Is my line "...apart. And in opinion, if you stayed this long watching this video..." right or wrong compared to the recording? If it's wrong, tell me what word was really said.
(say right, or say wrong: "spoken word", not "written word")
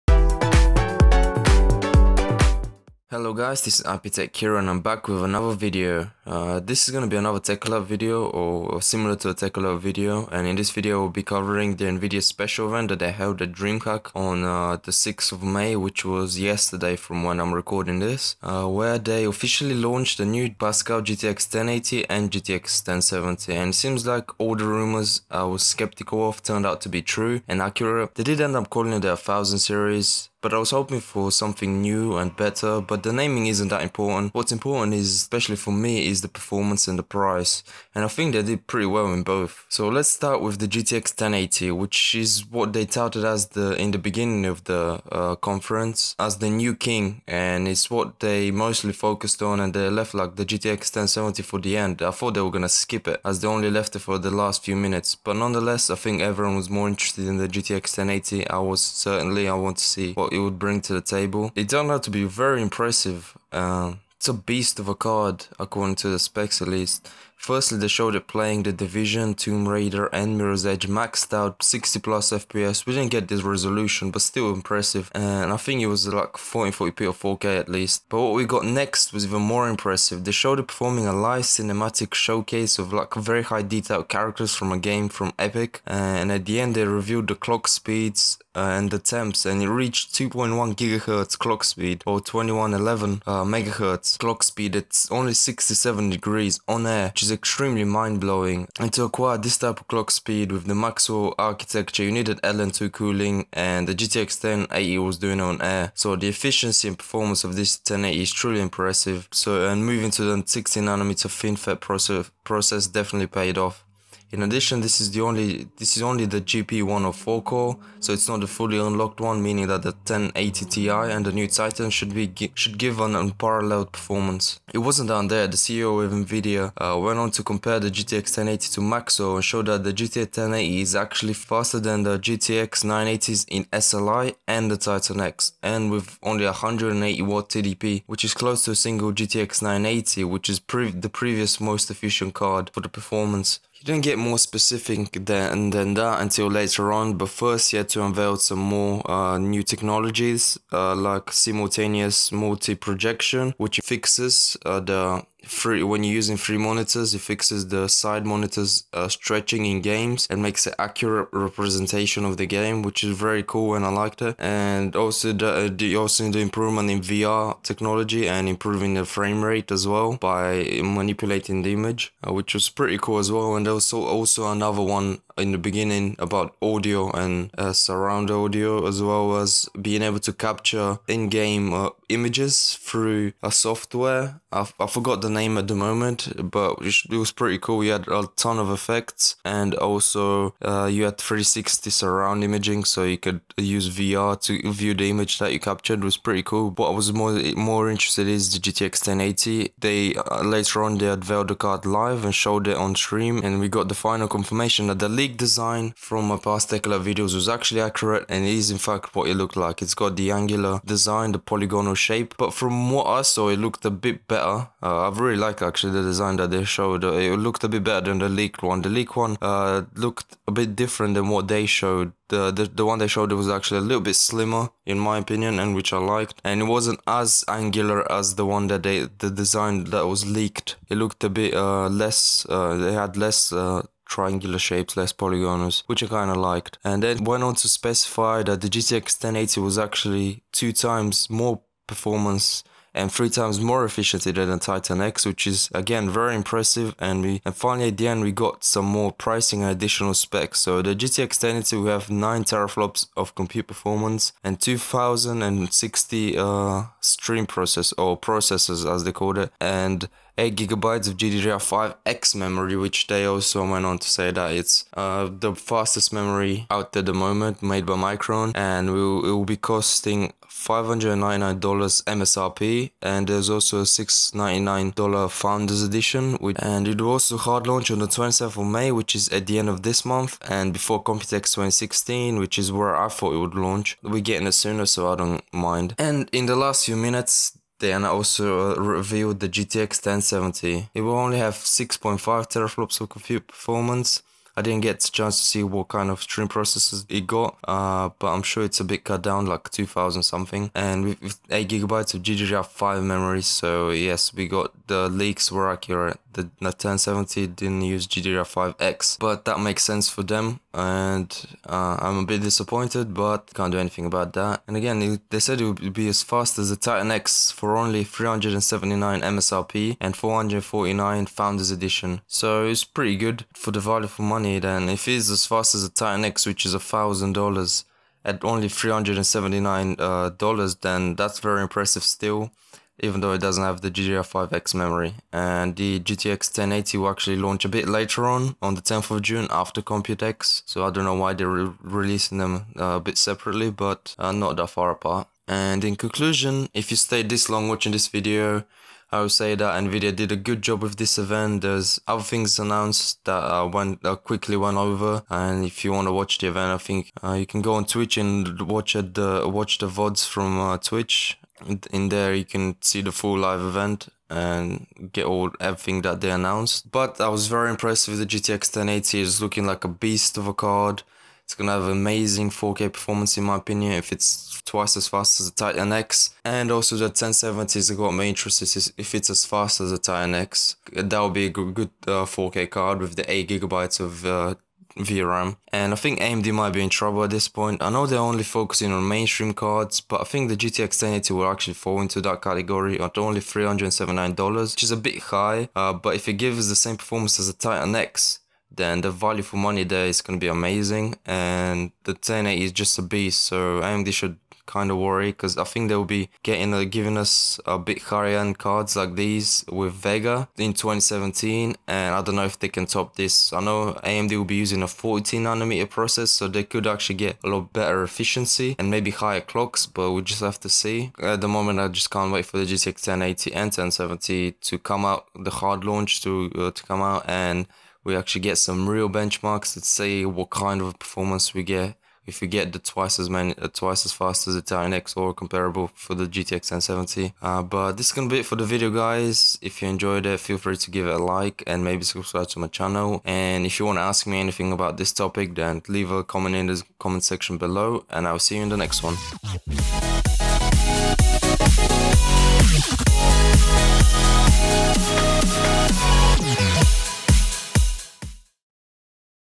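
wrong: "conclusion", not "opinion".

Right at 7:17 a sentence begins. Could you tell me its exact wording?
Uh, but this is gonna be it for the video, guys.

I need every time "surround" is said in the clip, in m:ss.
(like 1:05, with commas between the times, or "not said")
2:57, 3:11.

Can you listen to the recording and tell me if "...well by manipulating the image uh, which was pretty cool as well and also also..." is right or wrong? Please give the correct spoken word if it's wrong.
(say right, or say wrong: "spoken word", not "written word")
right.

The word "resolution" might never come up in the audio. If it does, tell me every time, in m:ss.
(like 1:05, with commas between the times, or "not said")
1:13.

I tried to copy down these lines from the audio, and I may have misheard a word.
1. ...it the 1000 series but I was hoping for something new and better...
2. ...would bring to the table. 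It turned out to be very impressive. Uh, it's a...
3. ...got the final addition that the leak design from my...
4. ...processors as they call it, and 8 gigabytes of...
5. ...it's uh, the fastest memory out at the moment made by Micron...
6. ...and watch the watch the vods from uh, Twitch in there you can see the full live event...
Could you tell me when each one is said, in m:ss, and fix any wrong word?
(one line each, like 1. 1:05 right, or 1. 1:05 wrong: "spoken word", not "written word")
1. 0:28 right
2. 1:00 right
3. 3:23 wrong: "confirmation", not "addition"
4. 4:18 right
5. 4:24 right
6. 5:58 right.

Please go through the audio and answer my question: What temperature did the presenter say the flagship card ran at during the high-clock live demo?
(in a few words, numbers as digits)
67 degrees.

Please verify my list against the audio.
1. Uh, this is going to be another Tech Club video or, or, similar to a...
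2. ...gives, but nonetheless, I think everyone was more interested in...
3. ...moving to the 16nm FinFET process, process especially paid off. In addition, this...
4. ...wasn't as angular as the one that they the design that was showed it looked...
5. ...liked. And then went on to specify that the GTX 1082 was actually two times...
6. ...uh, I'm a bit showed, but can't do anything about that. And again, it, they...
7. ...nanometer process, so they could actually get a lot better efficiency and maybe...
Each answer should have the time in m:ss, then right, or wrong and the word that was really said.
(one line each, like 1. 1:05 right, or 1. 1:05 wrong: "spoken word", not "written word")
1. 0:06 right
2. 0:54 wrong: "minutes", not "gives"
3. 1:49 wrong: "definitely", not "especially"
4. 3:46 wrong: "leaked", not "showed"
5. 3:56 wrong: "1080", not "1082"
6. 5:11 wrong: "disappointed", not "showed"
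7. 6:55 right.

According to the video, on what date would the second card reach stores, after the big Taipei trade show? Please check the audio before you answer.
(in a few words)
10 June.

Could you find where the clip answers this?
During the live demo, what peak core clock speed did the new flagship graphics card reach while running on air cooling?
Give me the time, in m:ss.
1:32.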